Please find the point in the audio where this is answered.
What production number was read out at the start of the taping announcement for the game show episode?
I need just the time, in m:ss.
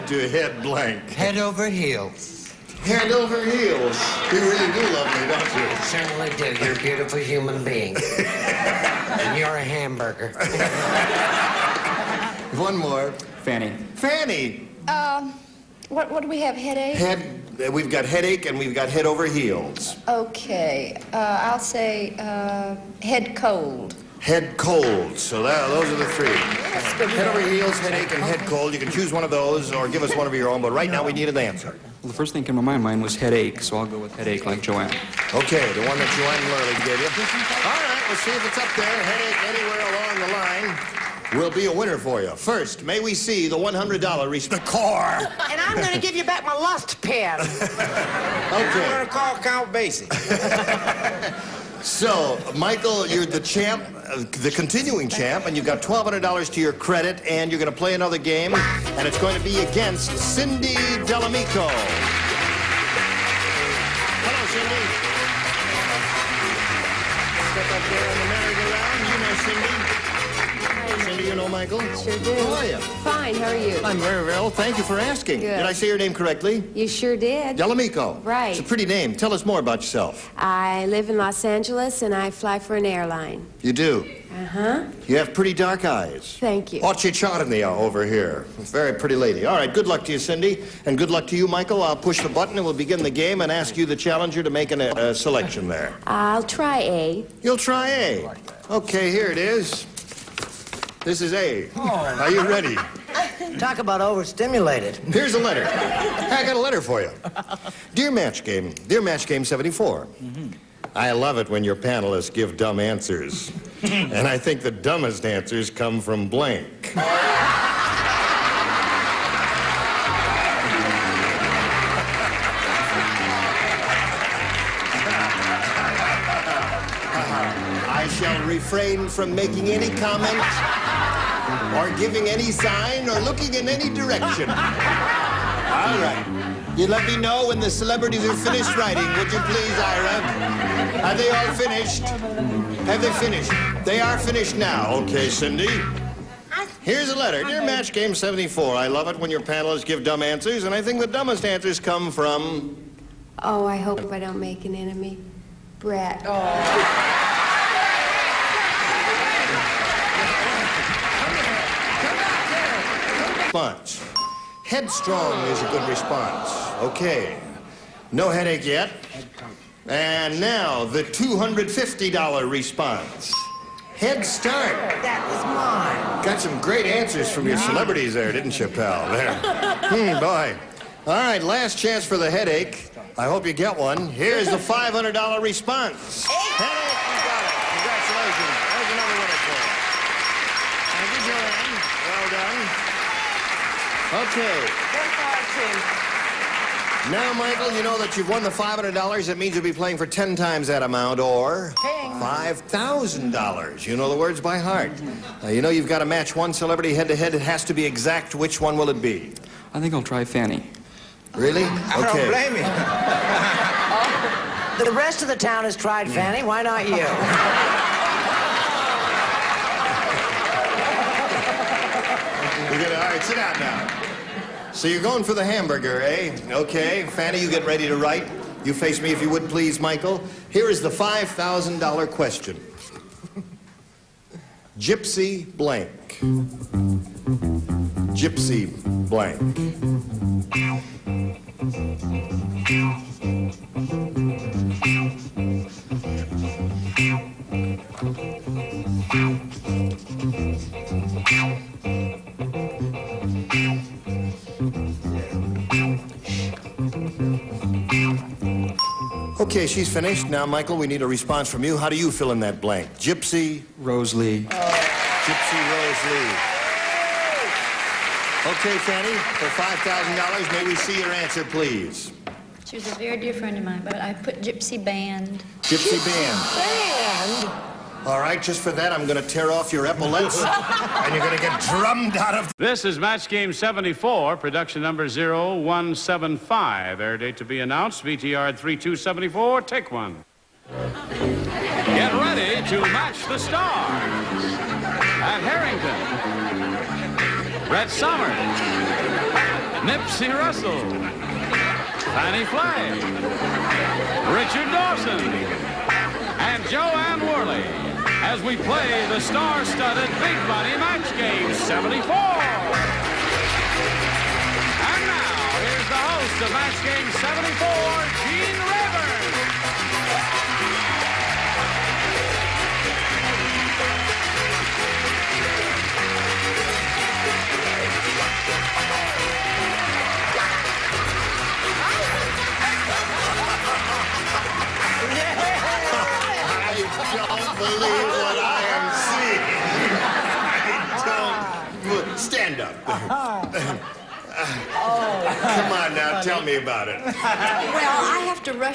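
4:45.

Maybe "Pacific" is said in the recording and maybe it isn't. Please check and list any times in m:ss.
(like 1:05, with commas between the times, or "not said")
not said.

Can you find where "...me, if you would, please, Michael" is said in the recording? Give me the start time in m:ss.
3:49.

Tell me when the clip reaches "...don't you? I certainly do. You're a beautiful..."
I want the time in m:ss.
0:05.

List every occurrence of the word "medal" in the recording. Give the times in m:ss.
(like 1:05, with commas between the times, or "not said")
not said.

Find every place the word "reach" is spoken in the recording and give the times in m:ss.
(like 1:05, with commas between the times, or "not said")
0:44.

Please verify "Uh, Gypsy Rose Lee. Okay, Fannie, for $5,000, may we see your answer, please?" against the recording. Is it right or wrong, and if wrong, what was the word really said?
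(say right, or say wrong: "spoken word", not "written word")
right.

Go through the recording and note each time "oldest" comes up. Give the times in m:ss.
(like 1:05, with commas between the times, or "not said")
not said.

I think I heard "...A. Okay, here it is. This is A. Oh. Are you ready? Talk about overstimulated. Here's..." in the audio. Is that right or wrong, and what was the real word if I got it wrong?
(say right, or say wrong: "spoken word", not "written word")
right.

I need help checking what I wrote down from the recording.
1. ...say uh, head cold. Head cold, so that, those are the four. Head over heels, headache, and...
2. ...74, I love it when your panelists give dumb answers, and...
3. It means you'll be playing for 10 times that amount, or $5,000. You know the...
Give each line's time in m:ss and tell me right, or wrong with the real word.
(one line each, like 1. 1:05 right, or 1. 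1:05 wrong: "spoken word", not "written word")
1. 0:21 wrong: "three", not "four"
2. 2:28 right
3. 3:19 right.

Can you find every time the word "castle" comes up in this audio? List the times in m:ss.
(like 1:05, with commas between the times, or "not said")
not said.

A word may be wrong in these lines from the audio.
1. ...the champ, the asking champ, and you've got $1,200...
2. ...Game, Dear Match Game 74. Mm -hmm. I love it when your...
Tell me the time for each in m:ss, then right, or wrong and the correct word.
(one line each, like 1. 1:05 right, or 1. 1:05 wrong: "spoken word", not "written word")
1. 0:53 wrong: "continuing", not "asking"
2. 1:48 right.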